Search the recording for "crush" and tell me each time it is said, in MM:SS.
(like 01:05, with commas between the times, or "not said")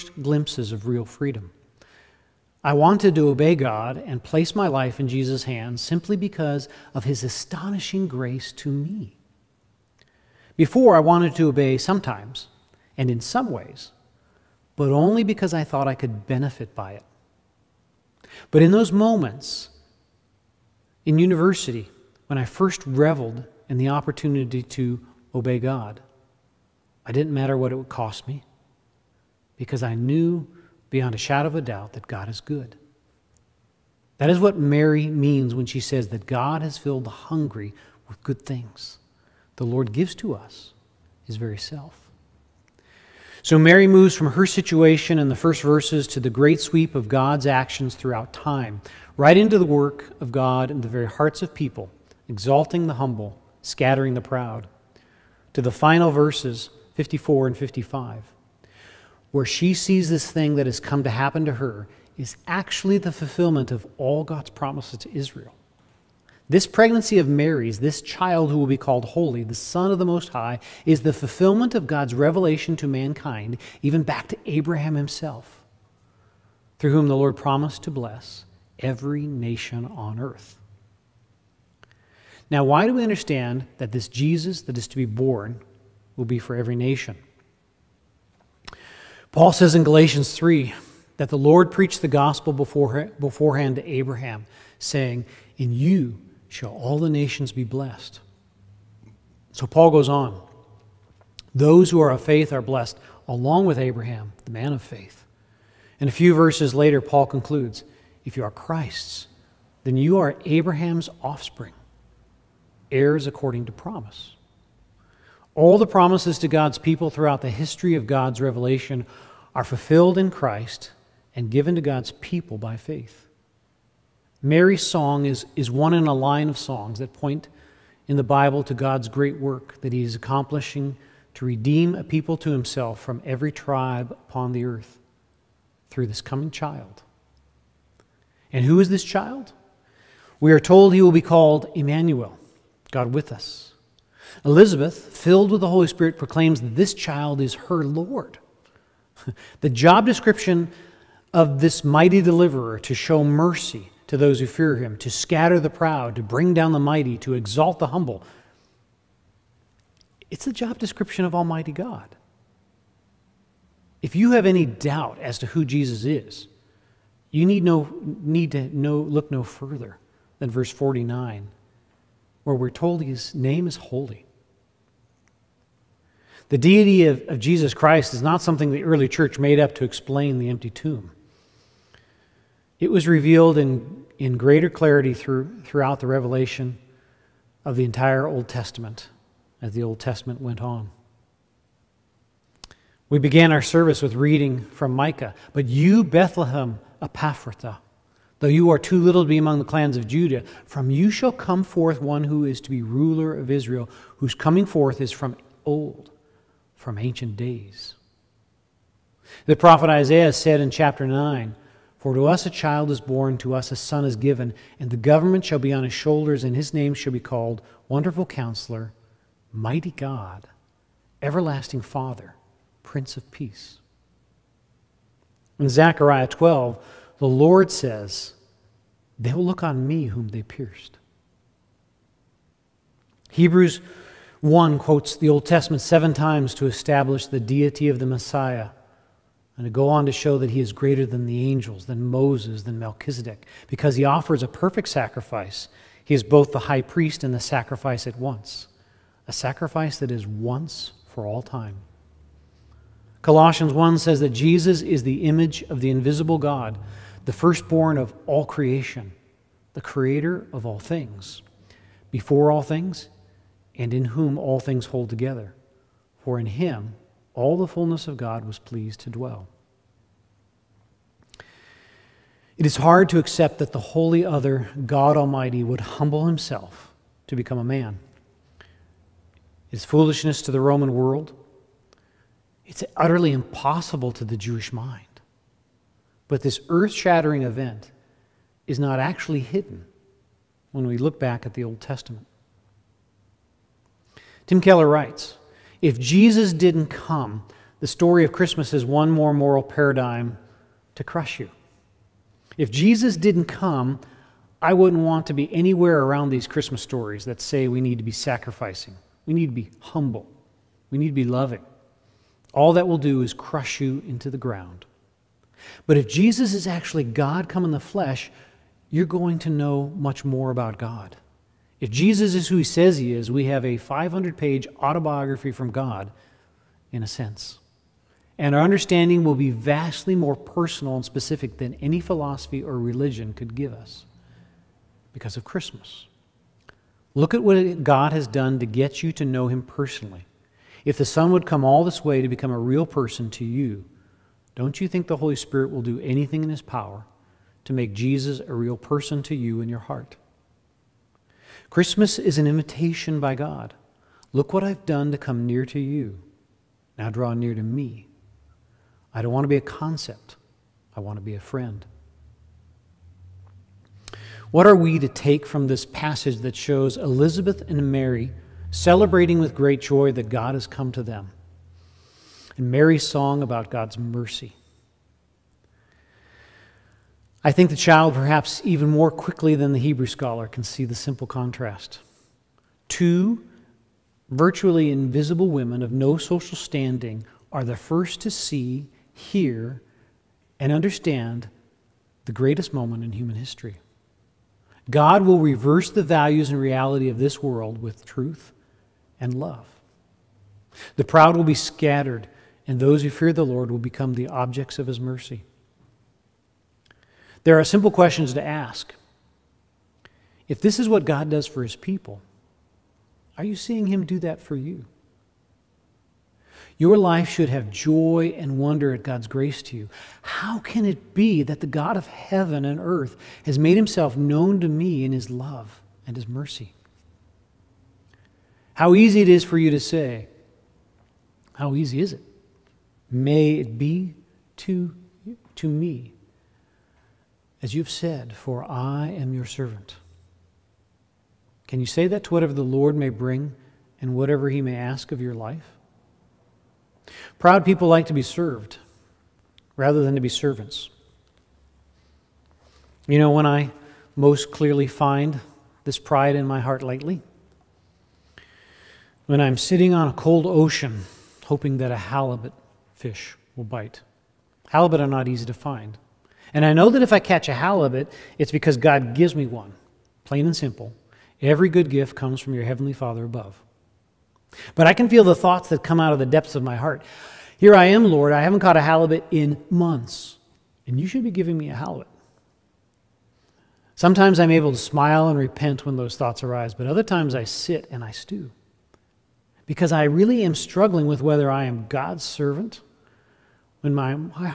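05:01, 05:13.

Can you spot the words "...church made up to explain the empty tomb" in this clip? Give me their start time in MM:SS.
02:59.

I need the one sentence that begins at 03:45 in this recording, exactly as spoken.
In Zechariah 12, the Lord says, They will look on me whom they pierced.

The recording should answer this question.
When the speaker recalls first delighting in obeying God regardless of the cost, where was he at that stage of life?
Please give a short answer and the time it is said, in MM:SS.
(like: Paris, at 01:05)
University, at 00:21.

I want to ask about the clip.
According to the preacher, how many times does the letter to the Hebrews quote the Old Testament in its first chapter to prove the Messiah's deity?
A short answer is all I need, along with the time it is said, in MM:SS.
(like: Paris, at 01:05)
7, at 03:55.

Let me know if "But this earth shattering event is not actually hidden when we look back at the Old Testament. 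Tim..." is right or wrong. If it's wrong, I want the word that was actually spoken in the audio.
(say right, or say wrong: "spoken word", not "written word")
right.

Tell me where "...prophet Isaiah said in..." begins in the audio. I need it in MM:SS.
03:29.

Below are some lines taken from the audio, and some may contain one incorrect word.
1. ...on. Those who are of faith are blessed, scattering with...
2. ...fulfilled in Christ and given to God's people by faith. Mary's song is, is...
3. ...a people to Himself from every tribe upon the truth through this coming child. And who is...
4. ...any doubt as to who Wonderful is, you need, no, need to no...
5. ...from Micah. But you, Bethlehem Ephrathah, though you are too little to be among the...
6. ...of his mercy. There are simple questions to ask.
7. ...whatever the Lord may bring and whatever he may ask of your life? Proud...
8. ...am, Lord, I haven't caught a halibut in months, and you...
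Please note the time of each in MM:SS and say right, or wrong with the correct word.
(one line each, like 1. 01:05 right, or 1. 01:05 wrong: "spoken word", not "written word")
1. 01:40 wrong: "along", not "scattering"
2. 01:59 right
3. 02:11 wrong: "earth", not "truth"
4. 02:44 wrong: "Jesus", not "Wonderful"
5. 03:14 right
6. 06:44 right
7. 07:22 right
8. 07:57 right.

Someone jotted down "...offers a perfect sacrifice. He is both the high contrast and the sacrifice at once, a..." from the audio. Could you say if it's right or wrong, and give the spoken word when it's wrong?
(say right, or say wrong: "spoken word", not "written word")
wrong: "priest", not "contrast".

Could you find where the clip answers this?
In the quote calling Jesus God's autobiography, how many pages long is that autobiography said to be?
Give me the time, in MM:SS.
05:23.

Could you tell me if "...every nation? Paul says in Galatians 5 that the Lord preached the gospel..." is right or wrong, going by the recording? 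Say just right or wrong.
wrong.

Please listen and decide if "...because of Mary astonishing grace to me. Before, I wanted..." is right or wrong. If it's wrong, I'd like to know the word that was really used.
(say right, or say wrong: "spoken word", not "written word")
wrong: "His", not "Mary".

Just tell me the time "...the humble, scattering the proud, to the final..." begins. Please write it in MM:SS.
00:52.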